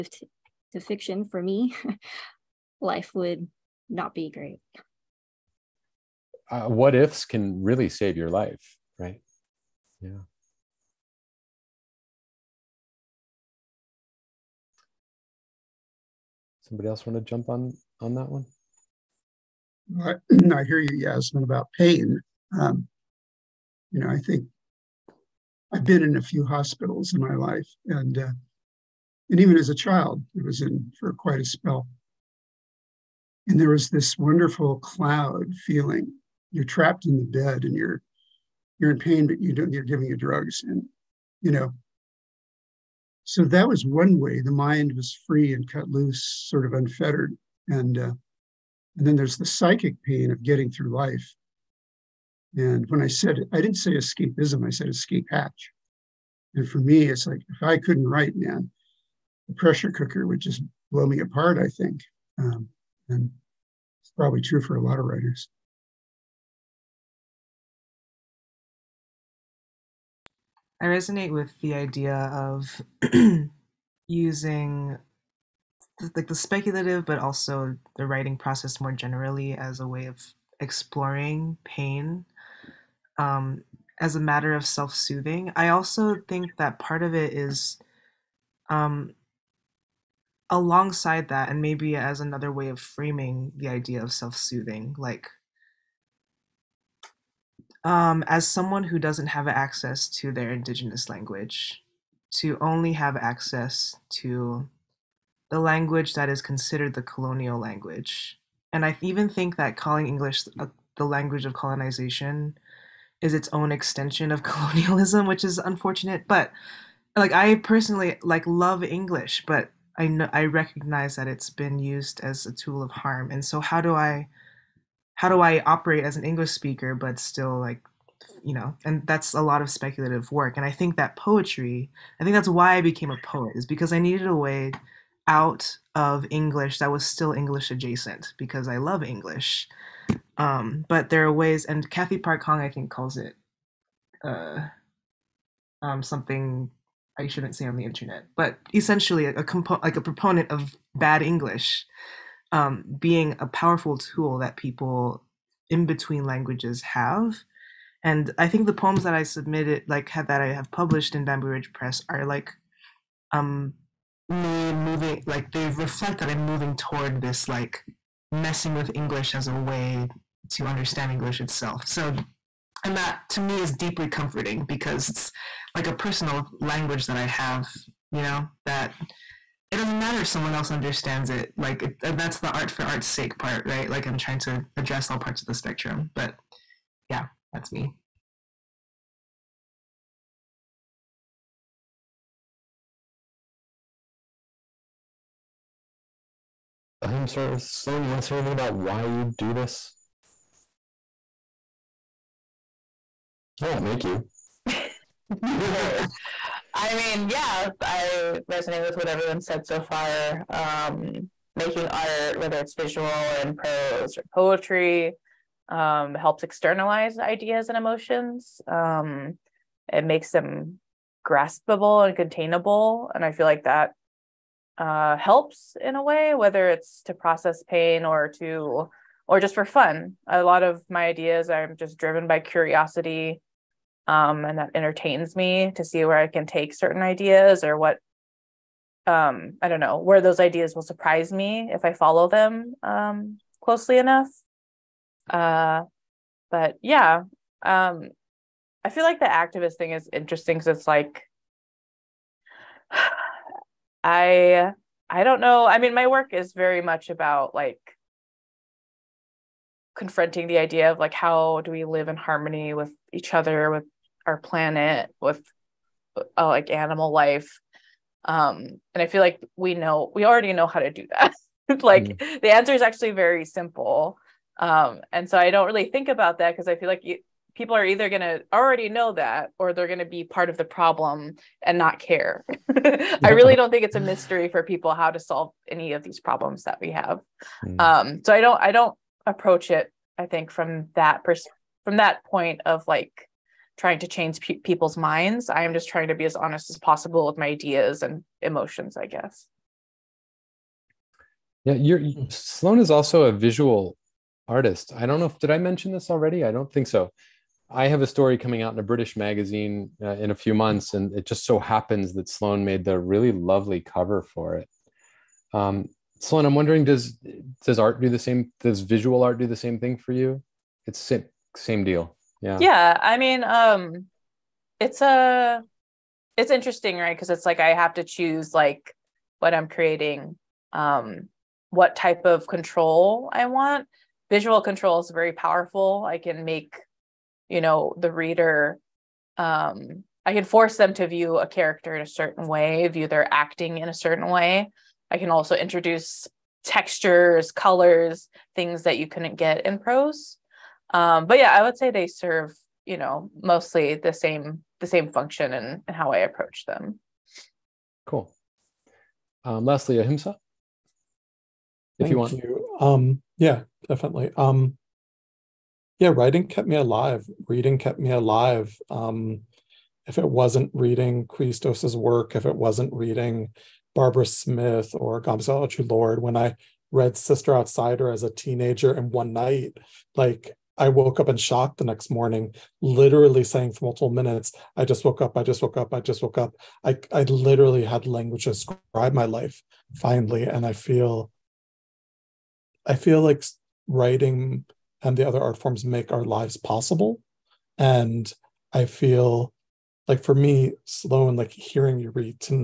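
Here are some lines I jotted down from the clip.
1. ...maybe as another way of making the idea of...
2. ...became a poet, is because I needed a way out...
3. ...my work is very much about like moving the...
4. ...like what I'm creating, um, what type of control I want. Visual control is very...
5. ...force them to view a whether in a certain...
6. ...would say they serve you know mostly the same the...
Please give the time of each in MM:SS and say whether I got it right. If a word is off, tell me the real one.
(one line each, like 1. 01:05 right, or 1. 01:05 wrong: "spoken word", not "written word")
1. 01:31 wrong: "framing", not "making"
2. 02:12 right
3. 04:15 wrong: "confronting", not "moving"
4. 05:28 right
5. 05:40 wrong: "character", not "whether"
6. 05:51 right.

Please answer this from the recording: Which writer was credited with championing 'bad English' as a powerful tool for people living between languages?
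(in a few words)
Cathy Park Hong.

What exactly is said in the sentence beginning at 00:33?
And there was this wonderful cloud feeling.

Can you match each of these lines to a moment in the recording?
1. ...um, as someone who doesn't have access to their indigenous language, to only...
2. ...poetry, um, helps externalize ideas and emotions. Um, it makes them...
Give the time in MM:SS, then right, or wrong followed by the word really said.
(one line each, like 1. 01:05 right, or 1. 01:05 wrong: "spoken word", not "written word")
1. 01:37 right
2. 03:34 right.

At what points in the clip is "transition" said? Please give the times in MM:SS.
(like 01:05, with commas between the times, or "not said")
not said.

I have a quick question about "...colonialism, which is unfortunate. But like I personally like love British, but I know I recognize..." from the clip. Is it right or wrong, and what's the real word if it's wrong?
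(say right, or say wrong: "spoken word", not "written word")
wrong: "English", not "British".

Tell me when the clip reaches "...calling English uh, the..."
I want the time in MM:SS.
01:49.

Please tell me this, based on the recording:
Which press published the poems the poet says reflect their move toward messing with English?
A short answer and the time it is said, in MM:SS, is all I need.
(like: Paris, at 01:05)
Bamboo Ridge Press, at 02:41.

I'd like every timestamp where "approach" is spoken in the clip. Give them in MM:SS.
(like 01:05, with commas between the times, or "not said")
04:49, 05:56.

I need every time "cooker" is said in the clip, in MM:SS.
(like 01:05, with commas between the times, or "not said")
00:59.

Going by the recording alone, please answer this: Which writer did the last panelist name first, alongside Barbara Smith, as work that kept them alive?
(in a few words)
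Chrystos.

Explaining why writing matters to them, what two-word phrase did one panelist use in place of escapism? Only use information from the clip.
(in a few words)
escape hatch.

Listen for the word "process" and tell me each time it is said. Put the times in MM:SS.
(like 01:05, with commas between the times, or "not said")
01:18, 03:47.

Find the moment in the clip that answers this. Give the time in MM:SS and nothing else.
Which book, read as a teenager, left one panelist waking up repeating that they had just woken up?
06:17.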